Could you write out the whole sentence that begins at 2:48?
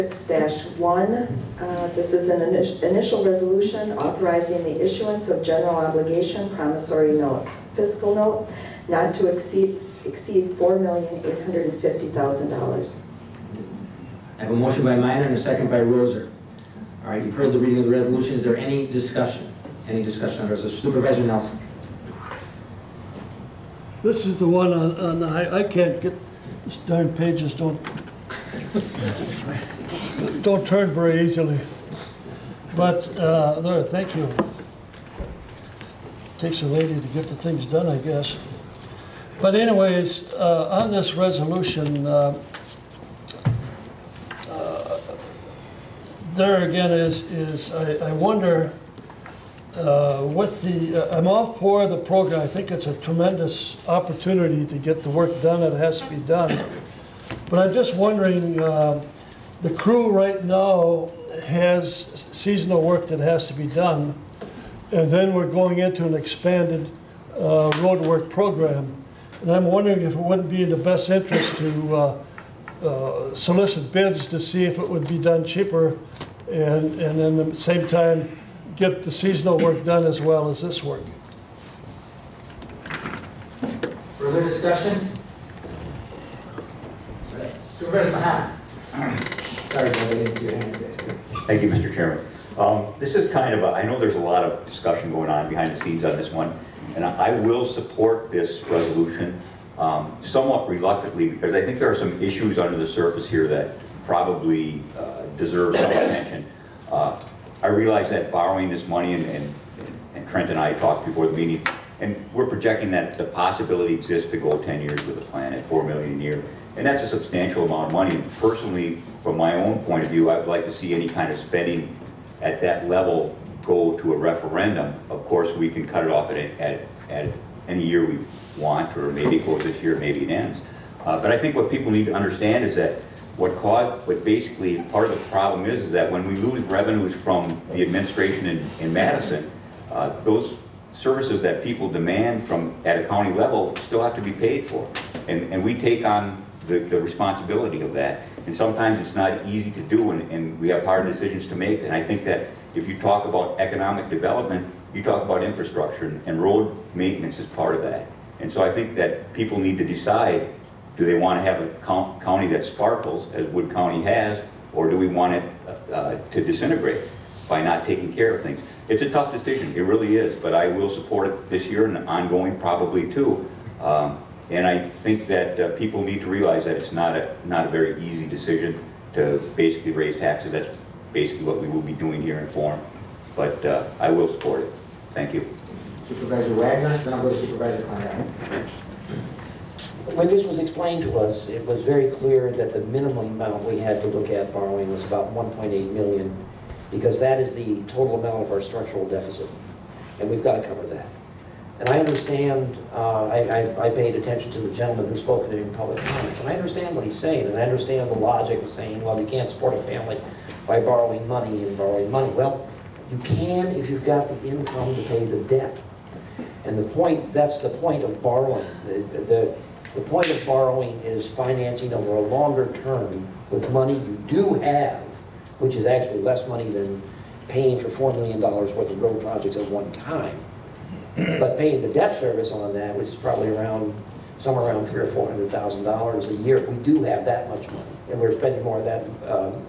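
It's a tough decision, it really is, but I will support it this year and ongoing probably too.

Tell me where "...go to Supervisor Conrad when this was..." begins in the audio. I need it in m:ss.
3:07.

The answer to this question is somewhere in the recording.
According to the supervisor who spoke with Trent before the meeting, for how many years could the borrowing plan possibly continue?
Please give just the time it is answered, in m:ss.
1:54.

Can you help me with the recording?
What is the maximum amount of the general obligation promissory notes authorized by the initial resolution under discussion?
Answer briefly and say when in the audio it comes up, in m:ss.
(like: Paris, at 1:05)
$4,850,000, at 0:10.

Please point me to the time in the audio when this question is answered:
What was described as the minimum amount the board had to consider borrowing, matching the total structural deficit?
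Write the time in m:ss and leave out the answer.
3:15.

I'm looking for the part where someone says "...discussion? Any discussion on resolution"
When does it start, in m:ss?
0:18.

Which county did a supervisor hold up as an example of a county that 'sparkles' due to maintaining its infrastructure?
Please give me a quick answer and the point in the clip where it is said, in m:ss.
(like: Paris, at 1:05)
Wood County, at 2:43.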